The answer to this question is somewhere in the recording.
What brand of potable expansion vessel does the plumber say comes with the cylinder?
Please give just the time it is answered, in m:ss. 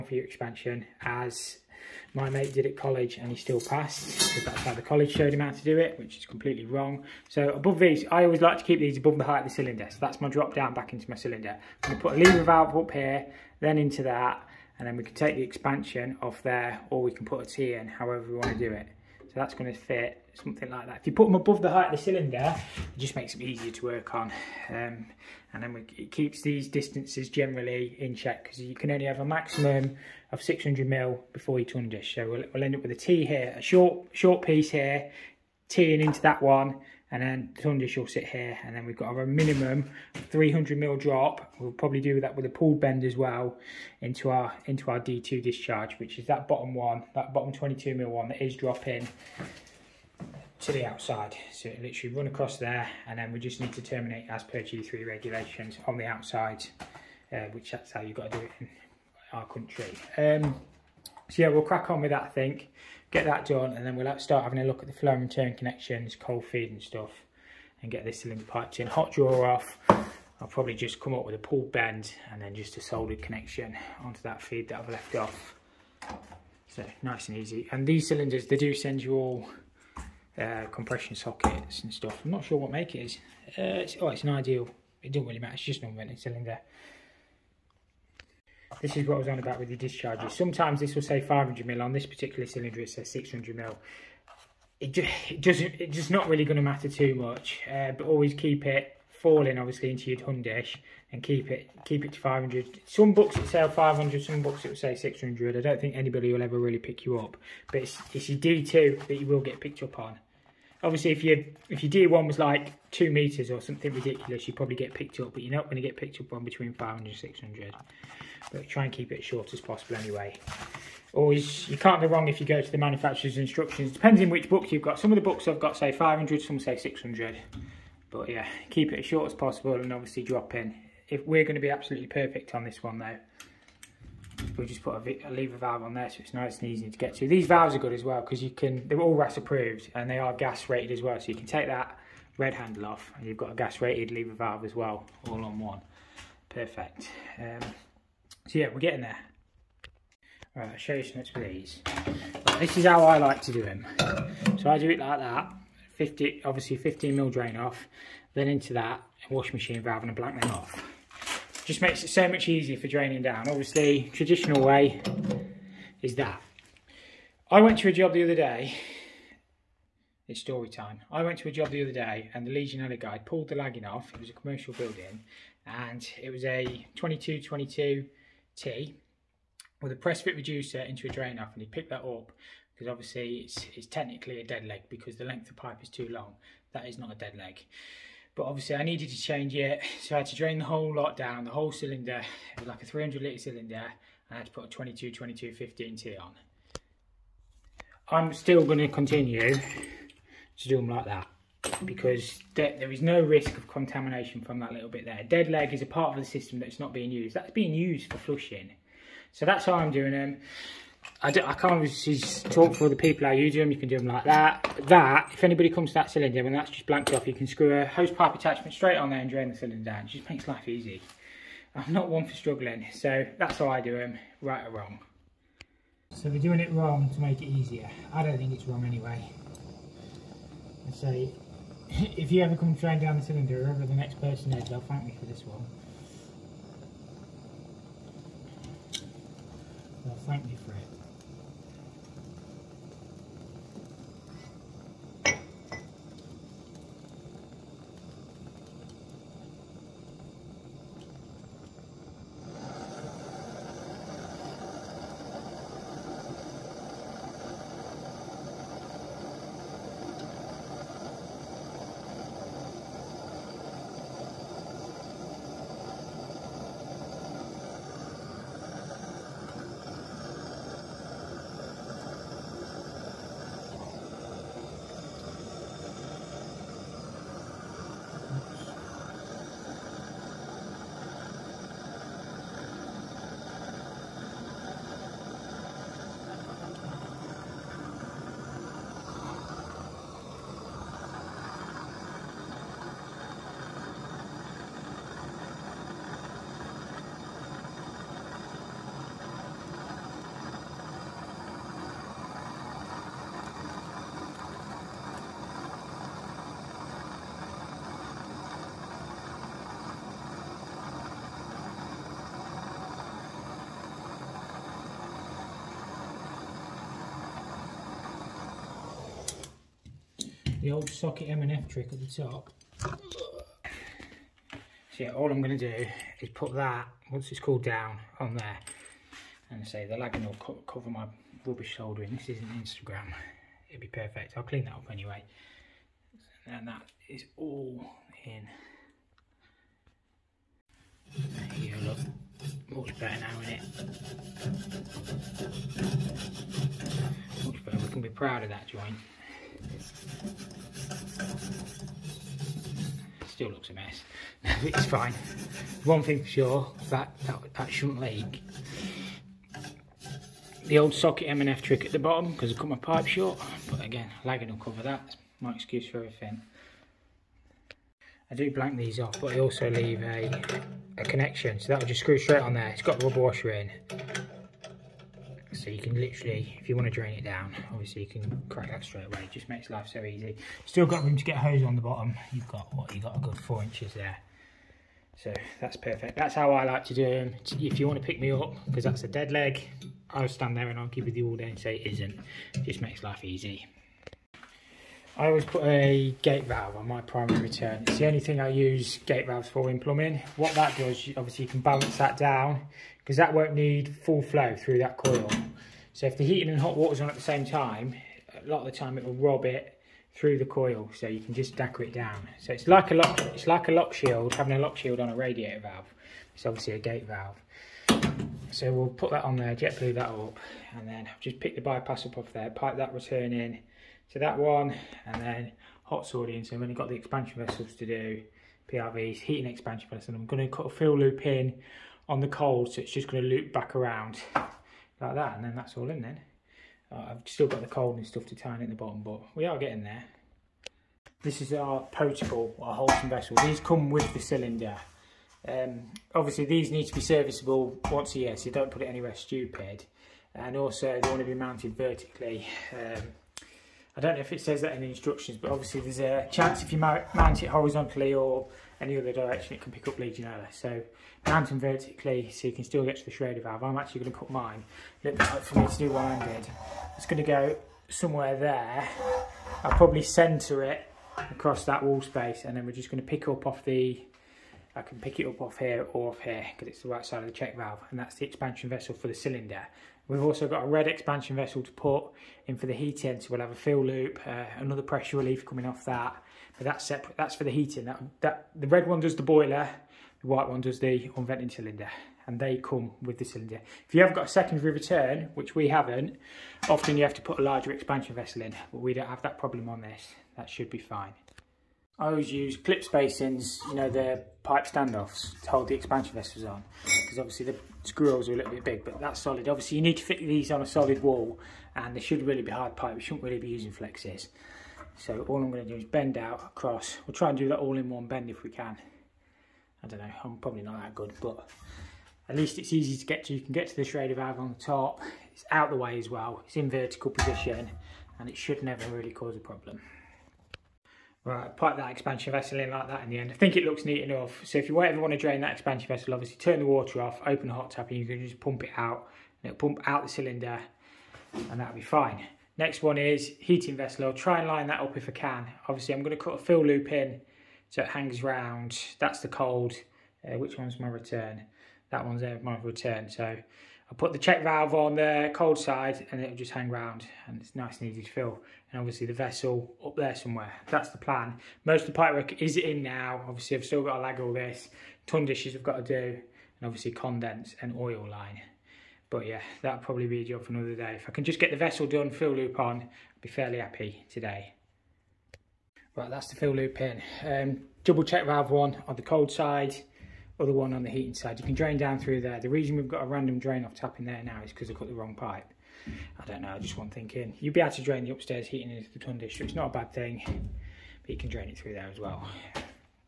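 7:22.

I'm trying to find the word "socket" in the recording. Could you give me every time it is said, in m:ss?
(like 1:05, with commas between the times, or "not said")
1:21, 5:20, 6:00.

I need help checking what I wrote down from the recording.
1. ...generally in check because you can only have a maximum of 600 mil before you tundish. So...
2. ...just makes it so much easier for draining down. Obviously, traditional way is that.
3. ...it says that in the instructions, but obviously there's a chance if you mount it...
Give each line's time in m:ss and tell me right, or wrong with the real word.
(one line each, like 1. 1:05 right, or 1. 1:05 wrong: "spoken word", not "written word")
1. 0:27 right
2. 2:41 right
3. 7:34 right.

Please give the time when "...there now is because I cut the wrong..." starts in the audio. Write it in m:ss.
9:44.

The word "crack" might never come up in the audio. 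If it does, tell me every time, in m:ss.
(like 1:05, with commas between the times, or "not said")
1:01, 6:18.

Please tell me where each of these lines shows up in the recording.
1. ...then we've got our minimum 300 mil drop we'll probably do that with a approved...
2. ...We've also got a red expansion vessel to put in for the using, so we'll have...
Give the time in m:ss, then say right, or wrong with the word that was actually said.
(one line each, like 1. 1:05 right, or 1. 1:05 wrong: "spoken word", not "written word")
1. 0:38 wrong: "pulled", not "approved"
2. 8:00 wrong: "heating", not "using".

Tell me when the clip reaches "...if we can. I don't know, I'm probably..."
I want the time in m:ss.
8:38.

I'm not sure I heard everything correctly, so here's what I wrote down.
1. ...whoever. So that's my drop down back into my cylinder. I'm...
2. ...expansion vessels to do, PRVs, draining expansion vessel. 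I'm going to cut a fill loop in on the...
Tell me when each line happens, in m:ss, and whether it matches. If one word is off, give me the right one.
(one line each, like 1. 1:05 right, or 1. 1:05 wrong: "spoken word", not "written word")
1. 0:09 wrong: "cylinder", not "whoever"
2. 7:06 wrong: "heating", not "draining".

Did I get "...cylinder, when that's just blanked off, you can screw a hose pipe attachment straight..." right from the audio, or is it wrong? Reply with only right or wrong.
right.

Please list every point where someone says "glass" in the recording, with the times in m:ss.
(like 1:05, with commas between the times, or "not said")
not said.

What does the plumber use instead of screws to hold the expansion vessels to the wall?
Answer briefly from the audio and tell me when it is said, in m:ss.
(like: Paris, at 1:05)
clip spacings, at 8:22.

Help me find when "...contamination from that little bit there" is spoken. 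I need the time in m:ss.
3:23.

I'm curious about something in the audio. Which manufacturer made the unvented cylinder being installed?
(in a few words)
Ideal.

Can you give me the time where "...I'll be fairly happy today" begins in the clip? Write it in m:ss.
9:32.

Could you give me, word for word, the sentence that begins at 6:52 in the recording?
So it's like a lock, it's like a lock shield, having a lock shield on a radiator valve.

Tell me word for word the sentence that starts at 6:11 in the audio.
So that'll just screw straight on there.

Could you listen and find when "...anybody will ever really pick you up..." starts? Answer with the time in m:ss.
1:45.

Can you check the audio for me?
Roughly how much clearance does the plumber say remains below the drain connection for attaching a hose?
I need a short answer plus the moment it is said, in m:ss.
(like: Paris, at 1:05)
4 inches, at 6:23.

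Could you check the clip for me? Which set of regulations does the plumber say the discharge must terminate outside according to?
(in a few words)
G3.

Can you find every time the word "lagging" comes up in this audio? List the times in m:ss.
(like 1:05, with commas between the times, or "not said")
2:53, 5:29, 6:04.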